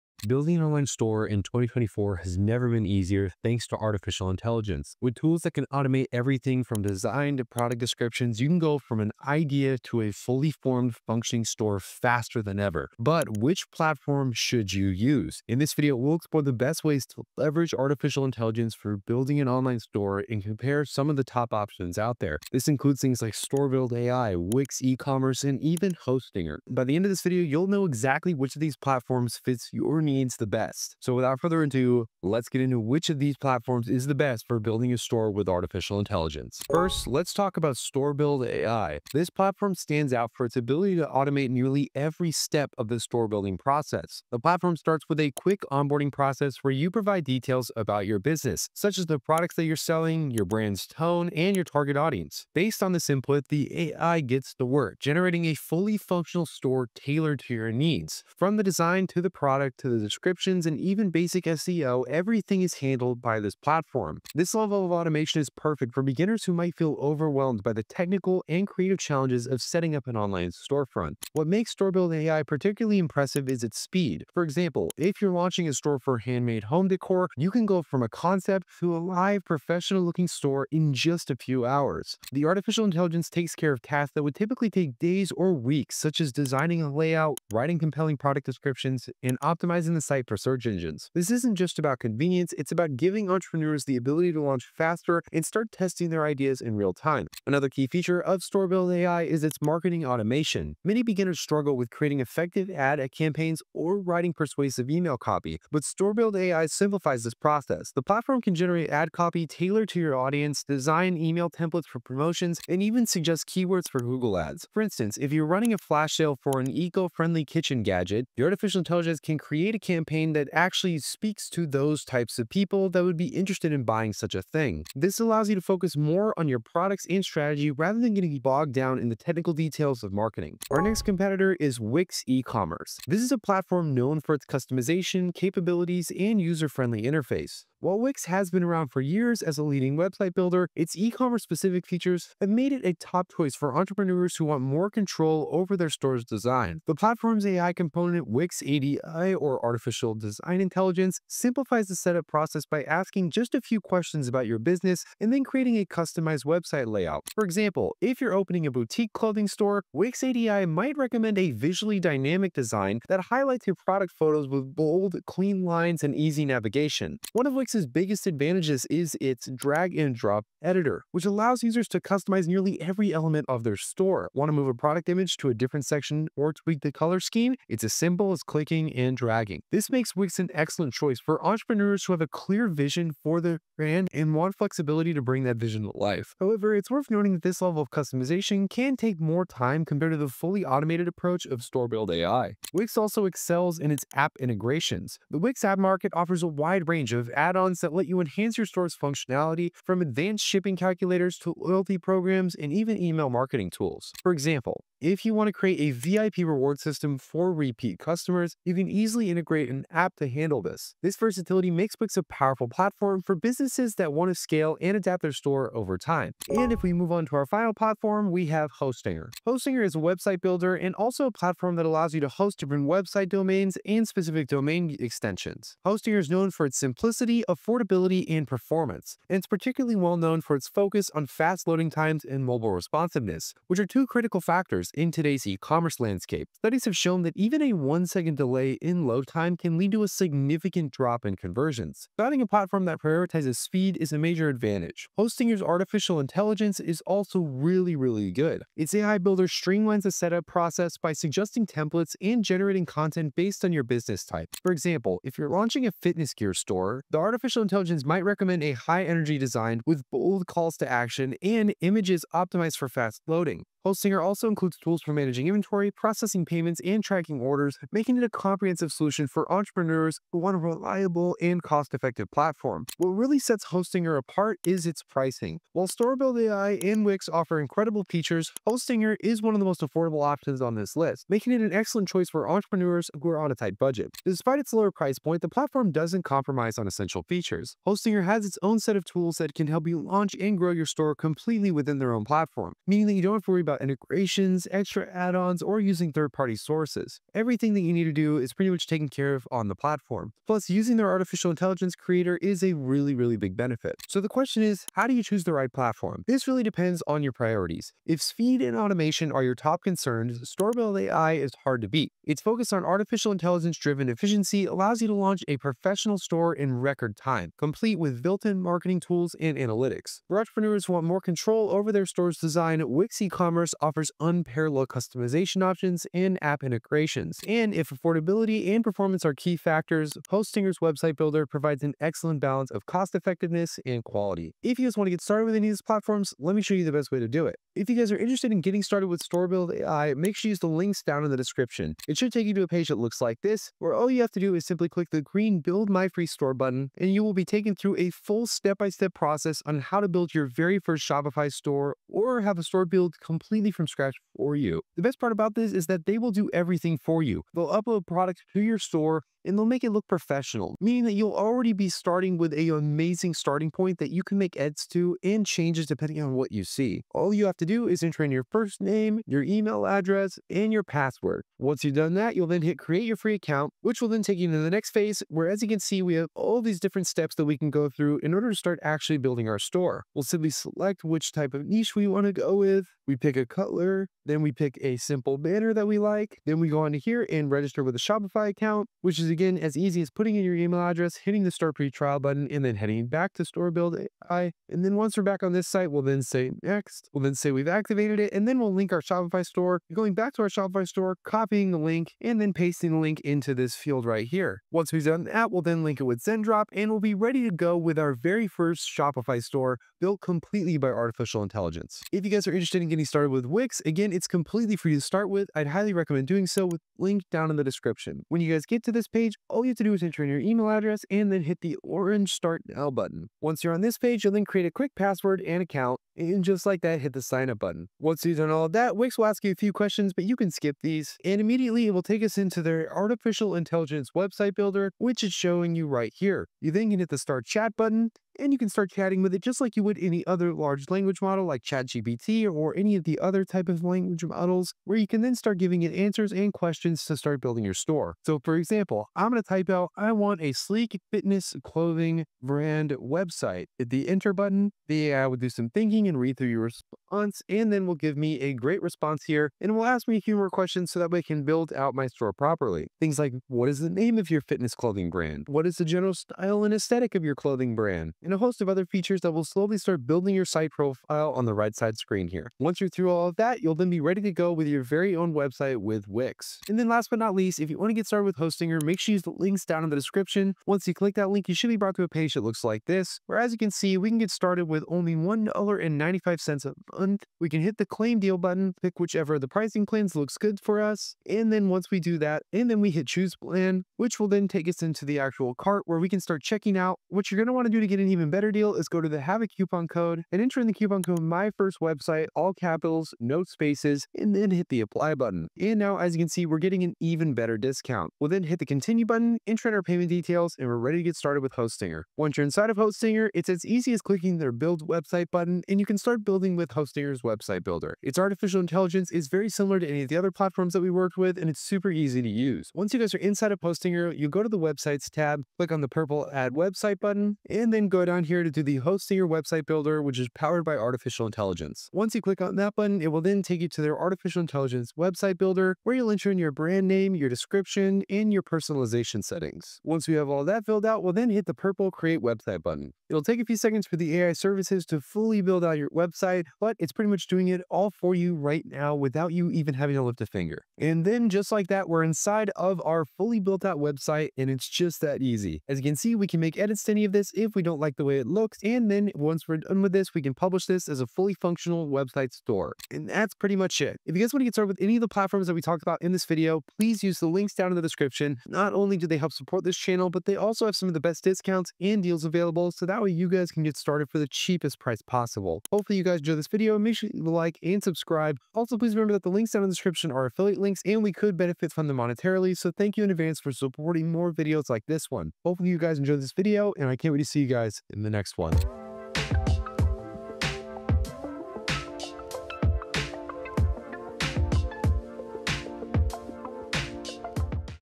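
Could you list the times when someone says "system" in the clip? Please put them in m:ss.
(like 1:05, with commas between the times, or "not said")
3:26.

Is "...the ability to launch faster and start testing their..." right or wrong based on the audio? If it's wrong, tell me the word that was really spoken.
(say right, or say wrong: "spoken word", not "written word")
right.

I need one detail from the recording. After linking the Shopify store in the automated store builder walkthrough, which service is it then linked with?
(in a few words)
Zendrop.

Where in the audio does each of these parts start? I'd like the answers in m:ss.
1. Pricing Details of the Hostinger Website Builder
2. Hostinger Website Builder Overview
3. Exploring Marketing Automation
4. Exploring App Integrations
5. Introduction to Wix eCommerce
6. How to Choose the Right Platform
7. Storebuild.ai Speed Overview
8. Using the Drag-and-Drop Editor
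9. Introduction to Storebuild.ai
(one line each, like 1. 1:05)
1. 4:32
2. 3:36
3. 1:37
4. 3:12
5. 2:10
6. 5:04
7. 1:11
8. 2:47
9. 0:36.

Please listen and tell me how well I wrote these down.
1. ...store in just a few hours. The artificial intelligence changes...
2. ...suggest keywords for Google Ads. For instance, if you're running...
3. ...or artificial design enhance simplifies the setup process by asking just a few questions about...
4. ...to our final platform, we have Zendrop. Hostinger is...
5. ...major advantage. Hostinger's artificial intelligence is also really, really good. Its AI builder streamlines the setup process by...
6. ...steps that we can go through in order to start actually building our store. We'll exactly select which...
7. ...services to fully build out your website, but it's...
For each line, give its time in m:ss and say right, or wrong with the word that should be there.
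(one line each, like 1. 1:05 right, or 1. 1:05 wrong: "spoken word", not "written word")
1. 1:20 wrong: "takes", not "changes"
2. 1:53 right
3. 2:29 wrong: "intelligence", not "enhance"
4. 3:37 wrong: "Hostinger", not "Zendrop"
5. 4:04 right
6. 6:17 wrong: "simply", not "exactly"
7. 9:04 right.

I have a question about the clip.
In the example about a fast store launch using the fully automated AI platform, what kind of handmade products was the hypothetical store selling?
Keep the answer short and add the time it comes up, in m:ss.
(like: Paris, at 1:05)
home decor, at 1:16.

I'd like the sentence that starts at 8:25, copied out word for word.
And now, as you can see, we're getting an even better discount.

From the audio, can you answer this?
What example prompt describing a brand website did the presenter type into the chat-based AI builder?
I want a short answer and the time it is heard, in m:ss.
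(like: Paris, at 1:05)
sleek fitness clothing brand, at 7:30.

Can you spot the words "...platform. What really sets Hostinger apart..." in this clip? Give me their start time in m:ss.
4:32.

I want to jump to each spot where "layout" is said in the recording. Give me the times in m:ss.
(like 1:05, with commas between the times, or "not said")
1:26, 2:36.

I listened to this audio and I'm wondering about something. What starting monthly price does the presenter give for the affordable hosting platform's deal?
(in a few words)
$1.95.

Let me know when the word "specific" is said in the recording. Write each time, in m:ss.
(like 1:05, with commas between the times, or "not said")
2:21, 3:44.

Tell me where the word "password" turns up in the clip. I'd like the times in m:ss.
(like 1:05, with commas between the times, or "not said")
6:10, 7:04.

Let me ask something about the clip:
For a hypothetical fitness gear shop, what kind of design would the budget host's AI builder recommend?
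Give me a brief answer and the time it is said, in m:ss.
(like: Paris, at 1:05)
high-energy design, at 4:18.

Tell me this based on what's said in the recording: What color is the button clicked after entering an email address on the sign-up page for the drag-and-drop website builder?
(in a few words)
orange.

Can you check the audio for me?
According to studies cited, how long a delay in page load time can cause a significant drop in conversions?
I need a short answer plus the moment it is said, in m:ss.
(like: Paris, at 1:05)
1 second, at 3:57.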